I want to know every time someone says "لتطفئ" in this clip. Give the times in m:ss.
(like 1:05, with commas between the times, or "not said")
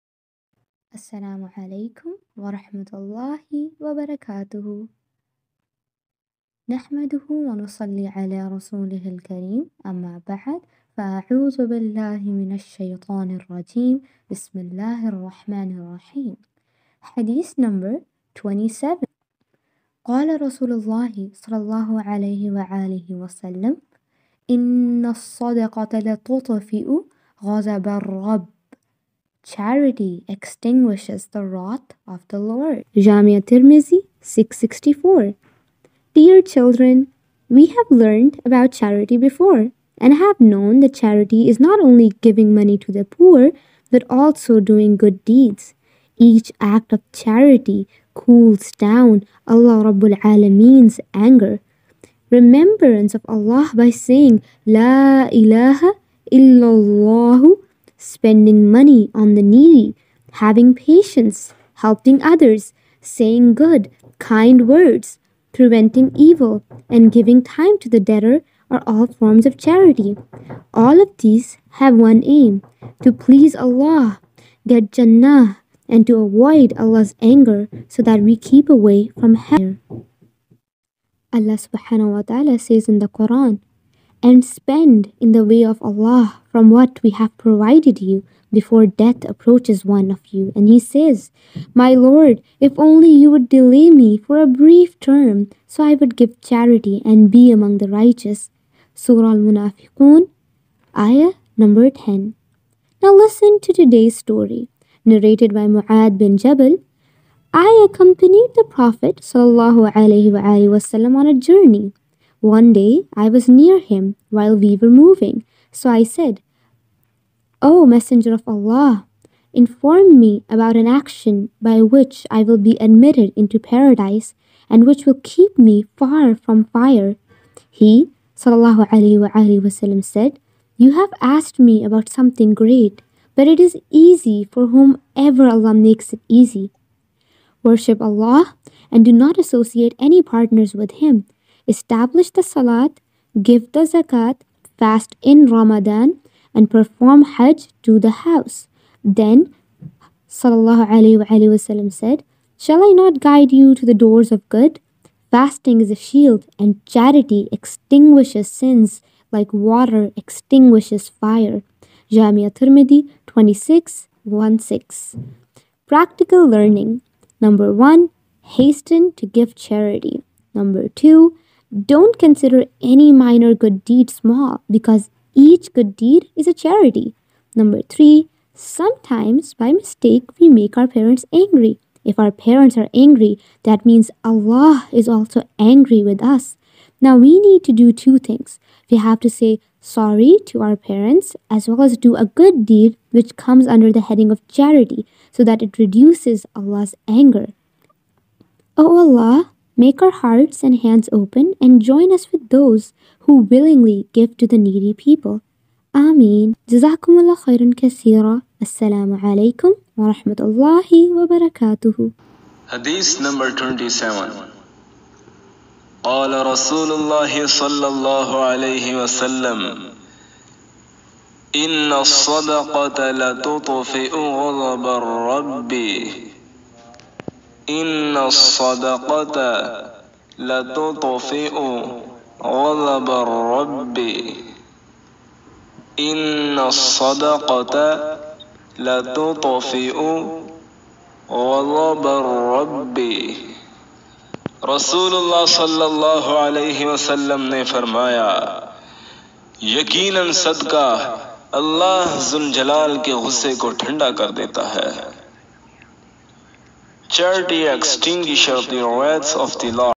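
0:25, 3:43, 3:50, 3:58.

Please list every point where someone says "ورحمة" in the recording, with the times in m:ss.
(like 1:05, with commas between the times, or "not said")
0:02.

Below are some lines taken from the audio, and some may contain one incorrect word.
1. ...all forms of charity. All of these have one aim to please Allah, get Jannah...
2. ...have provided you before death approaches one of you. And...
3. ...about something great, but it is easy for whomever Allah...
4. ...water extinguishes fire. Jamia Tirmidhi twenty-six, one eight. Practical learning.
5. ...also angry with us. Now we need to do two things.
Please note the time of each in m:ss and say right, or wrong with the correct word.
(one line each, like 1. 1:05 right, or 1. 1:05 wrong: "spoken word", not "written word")
1. 1:08 right
2. 1:27 right
3. 2:11 right
4. 2:39 wrong: "six", not "eight"
5. 3:05 right.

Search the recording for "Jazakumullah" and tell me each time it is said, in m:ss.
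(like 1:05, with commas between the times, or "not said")
3:26.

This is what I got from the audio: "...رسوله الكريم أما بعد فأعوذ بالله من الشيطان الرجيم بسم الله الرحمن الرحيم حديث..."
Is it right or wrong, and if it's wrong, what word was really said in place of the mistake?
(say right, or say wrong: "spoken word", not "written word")
right.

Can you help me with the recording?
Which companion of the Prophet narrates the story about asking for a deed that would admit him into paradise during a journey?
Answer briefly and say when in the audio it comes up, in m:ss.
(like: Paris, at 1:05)
Mu'ad bin Jabal, at 1:45.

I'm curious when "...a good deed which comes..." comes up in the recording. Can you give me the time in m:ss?
3:12.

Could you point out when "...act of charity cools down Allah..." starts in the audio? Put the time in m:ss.
0:46.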